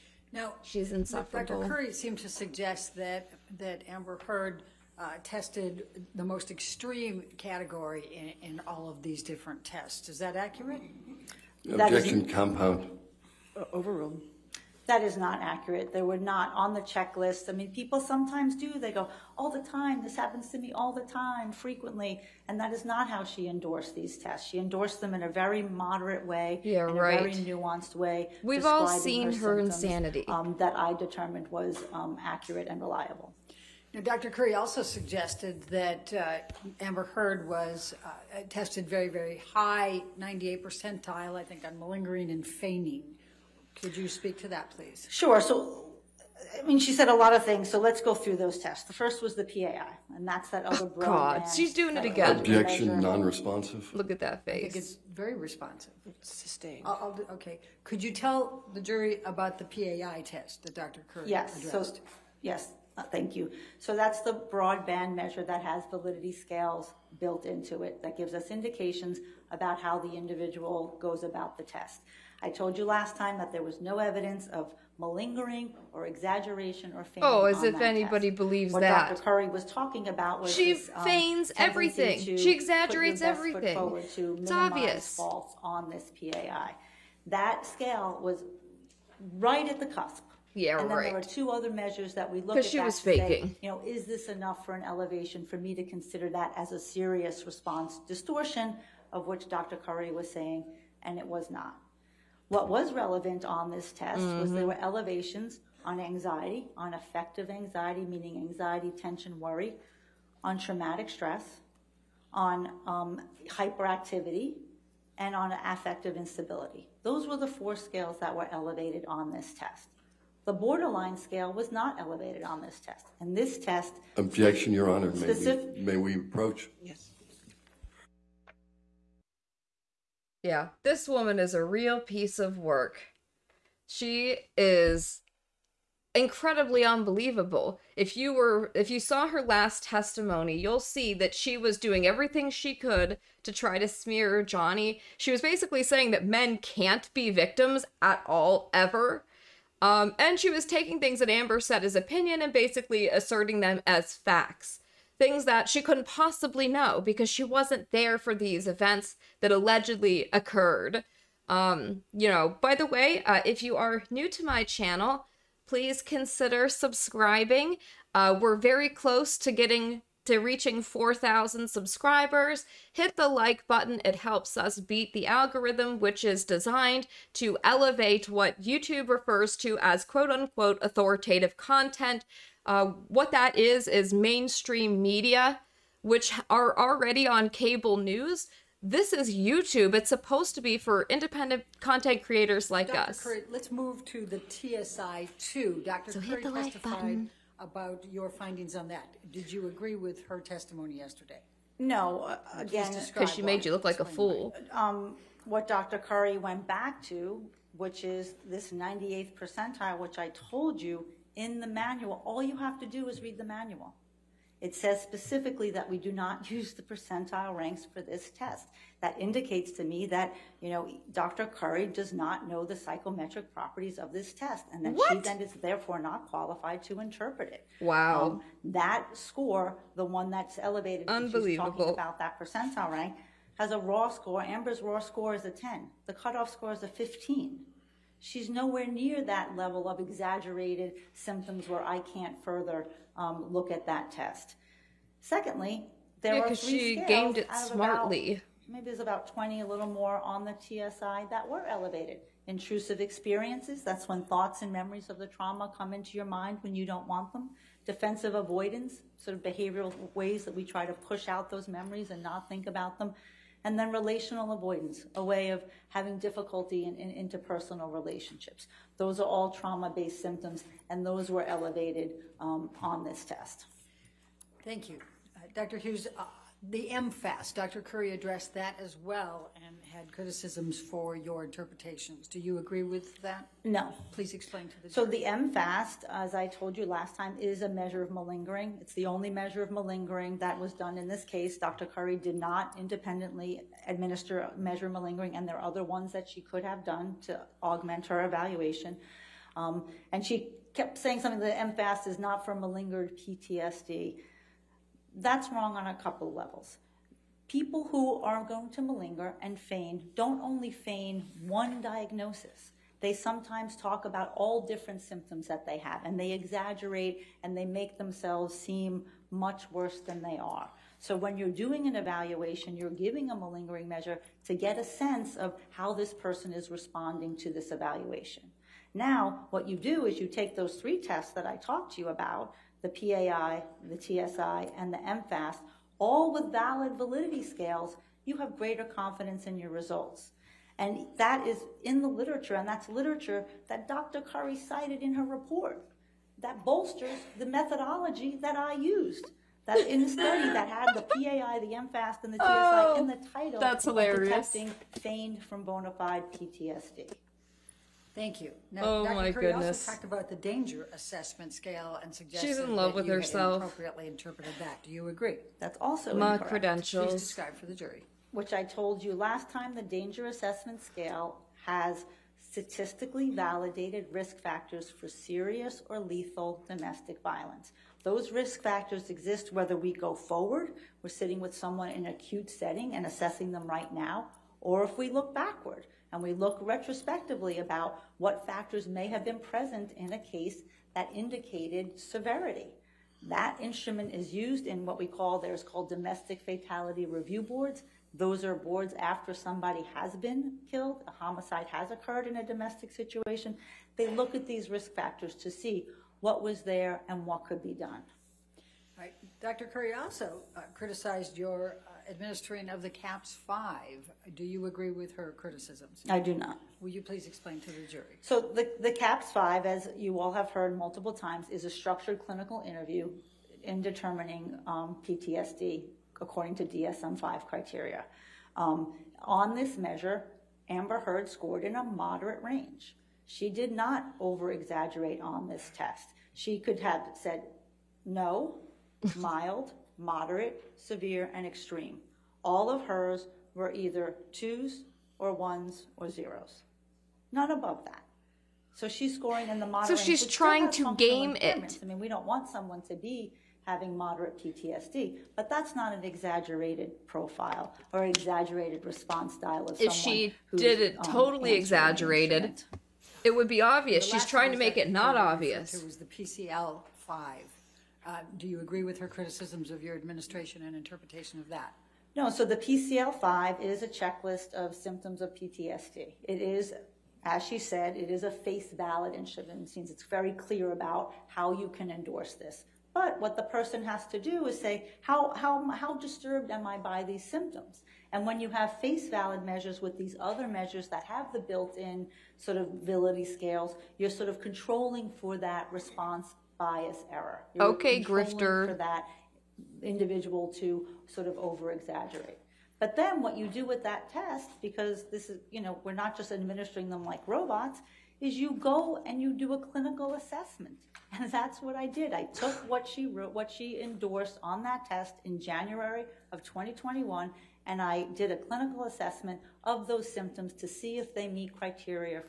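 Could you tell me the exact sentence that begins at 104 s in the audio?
were elevations on anxiety, on affective anxiety, meaning anxiety, tension, worry, on traumatic stress, on um, hyperactivity, and on affective instability.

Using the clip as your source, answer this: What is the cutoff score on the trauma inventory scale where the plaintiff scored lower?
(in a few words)
15.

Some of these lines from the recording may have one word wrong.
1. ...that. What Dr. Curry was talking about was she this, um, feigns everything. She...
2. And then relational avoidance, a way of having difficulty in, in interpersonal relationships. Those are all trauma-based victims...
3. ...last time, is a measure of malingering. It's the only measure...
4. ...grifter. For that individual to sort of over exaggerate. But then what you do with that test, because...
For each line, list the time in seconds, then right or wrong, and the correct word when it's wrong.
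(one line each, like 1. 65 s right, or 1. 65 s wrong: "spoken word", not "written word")
1. 78 s right
2. 263 s wrong: "symptoms", not "victims"
3. 286 s right
4. 498 s right.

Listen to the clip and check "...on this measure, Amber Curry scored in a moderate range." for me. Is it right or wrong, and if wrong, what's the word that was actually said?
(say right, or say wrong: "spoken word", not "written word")
wrong: "Heard", not "Curry".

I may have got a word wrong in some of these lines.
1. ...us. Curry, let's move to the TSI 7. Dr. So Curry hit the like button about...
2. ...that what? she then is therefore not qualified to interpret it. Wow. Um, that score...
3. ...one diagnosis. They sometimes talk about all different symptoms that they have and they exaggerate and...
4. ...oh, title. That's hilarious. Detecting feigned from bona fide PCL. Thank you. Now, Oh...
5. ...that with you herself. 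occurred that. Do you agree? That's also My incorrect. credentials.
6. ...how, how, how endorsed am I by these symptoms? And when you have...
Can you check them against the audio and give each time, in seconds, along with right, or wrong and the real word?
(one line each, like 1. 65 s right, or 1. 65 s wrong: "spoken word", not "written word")
1. 192 s wrong: "2", not "7"
2. 224 s right
3. 311 s right
4. 353 s wrong: "PTSD", not "PCL"
5. 362 s wrong: "interpreted", not "occurred"
6. 485 s wrong: "disturbed", not "endorsed".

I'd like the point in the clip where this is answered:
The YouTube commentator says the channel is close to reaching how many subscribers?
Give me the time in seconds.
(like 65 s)
170 s.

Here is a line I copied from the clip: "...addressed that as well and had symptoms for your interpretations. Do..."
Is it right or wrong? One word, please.
wrong.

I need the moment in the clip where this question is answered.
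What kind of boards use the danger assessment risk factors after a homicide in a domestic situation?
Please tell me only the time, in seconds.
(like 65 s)
395 s.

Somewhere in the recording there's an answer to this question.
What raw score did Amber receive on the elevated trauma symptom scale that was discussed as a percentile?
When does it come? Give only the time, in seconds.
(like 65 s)
234 s.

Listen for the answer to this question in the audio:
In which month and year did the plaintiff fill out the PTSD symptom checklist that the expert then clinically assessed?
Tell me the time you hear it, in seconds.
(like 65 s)
515 s.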